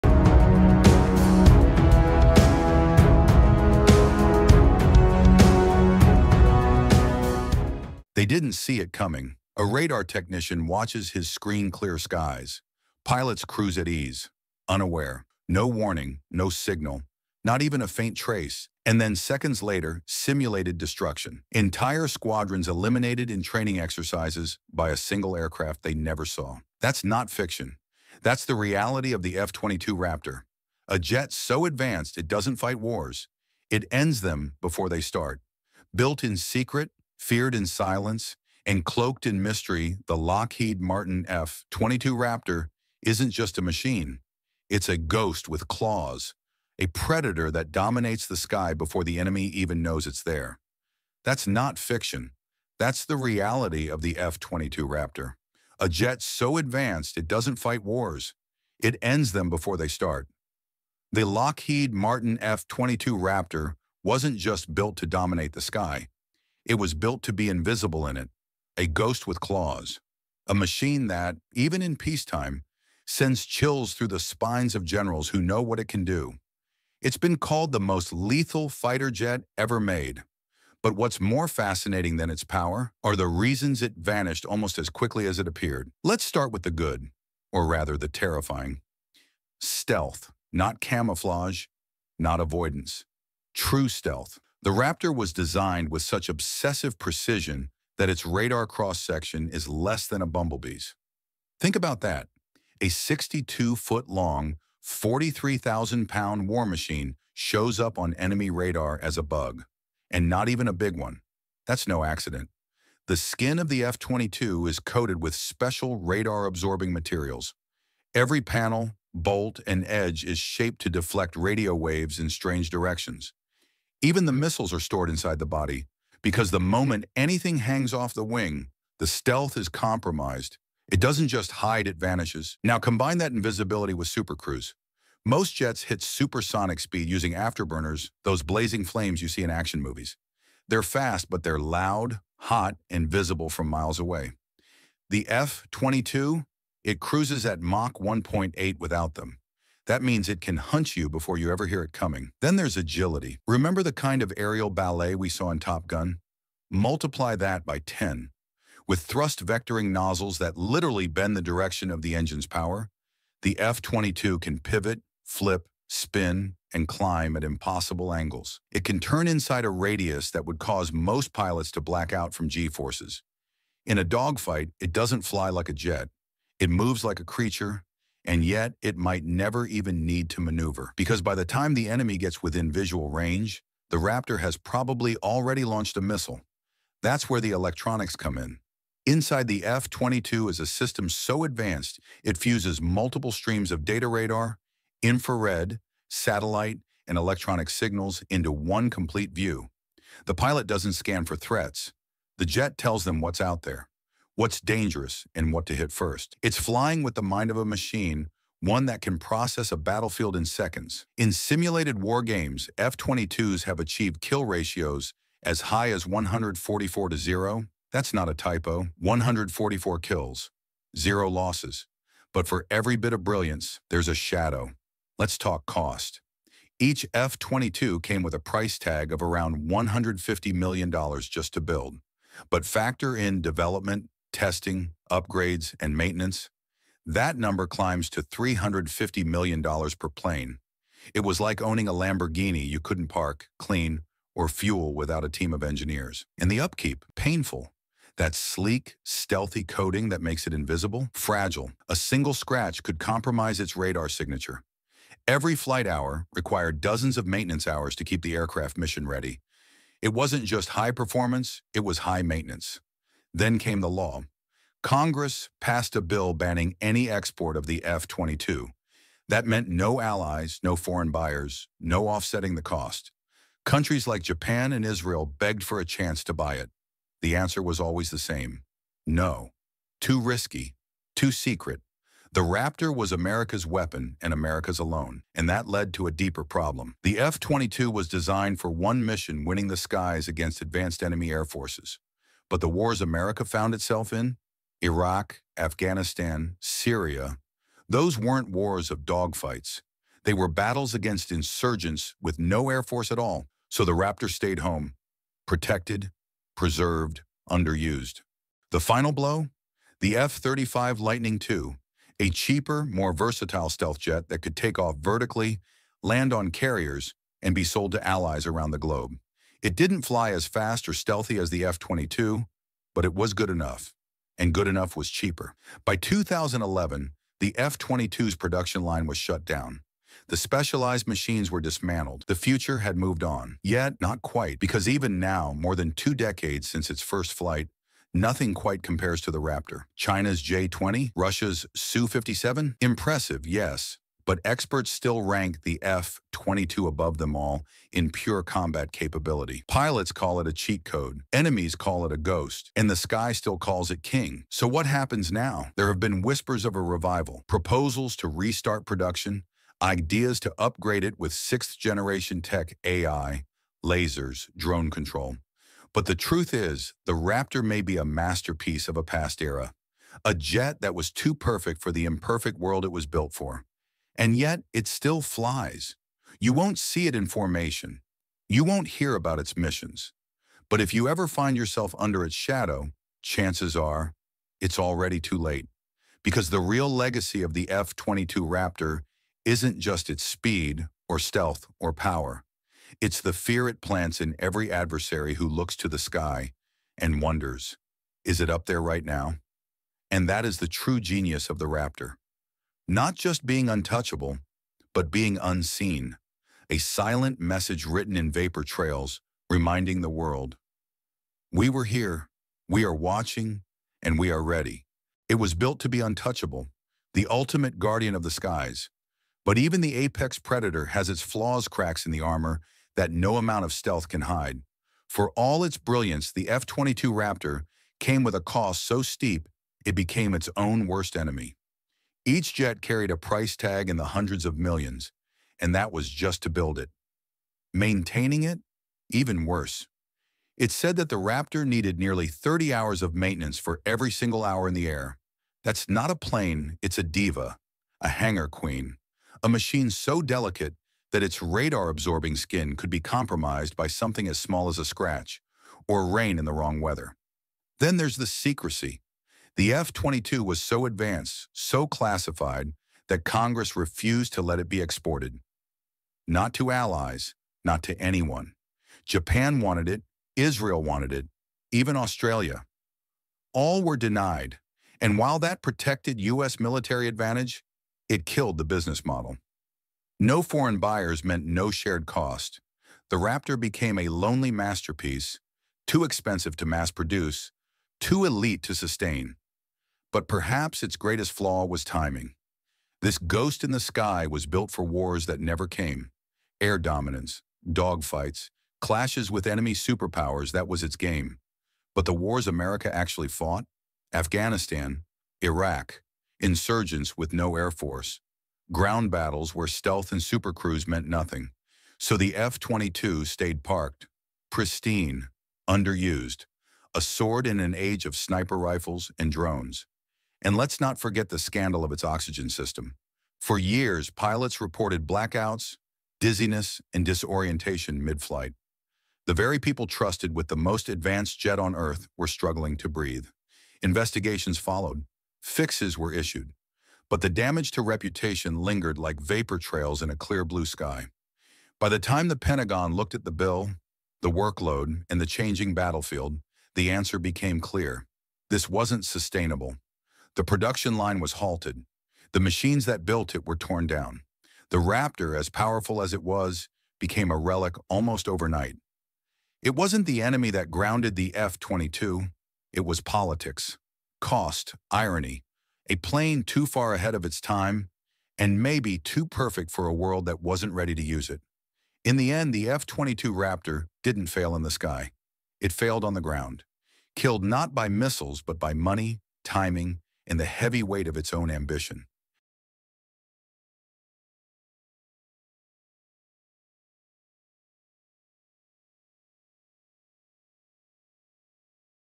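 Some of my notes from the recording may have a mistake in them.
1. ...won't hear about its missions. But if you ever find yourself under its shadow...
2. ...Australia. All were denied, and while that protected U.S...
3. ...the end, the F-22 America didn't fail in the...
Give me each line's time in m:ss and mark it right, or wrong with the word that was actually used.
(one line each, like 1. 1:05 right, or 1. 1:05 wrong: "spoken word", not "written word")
1. 6:18 right
2. 7:51 right
3. 9:32 wrong: "Raptor", not "America".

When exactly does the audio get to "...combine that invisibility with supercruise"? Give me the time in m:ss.
2:12.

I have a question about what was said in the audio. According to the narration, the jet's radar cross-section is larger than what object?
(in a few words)
a bumblebee.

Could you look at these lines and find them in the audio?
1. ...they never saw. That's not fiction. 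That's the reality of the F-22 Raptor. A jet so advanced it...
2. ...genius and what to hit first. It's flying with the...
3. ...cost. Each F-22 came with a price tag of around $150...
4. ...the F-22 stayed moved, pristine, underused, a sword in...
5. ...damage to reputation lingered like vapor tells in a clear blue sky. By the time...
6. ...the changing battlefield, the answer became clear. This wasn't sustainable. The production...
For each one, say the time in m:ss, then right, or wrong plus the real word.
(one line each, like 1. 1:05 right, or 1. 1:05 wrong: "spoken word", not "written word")
1. 0:25 right
2. 3:24 wrong: "dangerous", not "genius"
3. 3:45 right
4. 8:32 wrong: "parked", not "moved"
5. 8:57 wrong: "trails", not "tells"
6. 9:05 right.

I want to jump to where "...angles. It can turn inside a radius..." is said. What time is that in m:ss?
2:48.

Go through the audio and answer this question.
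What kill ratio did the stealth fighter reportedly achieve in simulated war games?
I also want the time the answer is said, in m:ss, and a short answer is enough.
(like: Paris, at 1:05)
144 to 0, at 3:36.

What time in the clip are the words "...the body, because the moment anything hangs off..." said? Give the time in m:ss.
2:05.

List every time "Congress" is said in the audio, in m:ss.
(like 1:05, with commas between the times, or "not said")
4:24, 7:43.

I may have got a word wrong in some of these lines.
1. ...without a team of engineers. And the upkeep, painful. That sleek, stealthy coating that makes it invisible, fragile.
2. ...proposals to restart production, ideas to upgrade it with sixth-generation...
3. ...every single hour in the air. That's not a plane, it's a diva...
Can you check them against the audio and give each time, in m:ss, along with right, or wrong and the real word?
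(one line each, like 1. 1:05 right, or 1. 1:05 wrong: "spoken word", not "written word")
1. 4:04 right
2. 5:57 right
3. 7:23 right.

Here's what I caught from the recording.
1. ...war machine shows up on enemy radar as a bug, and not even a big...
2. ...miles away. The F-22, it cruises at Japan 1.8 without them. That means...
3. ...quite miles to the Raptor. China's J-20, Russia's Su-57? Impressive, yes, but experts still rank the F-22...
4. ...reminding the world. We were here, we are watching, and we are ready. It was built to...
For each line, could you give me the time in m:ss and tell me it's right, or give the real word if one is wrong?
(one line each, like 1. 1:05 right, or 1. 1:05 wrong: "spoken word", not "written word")
1. 1:46 right
2. 2:23 wrong: "Mach", not "Japan"
3. 5:38 wrong: "compares", not "miles"
4. 6:49 right.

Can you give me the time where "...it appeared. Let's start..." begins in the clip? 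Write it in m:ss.
1:25.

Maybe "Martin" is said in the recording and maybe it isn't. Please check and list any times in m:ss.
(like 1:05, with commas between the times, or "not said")
0:40, 1:01.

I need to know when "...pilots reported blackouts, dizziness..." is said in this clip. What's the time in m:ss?
8:44.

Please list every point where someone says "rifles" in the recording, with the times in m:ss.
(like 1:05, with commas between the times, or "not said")
8:38.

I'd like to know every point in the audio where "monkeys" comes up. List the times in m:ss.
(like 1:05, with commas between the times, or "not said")
not said.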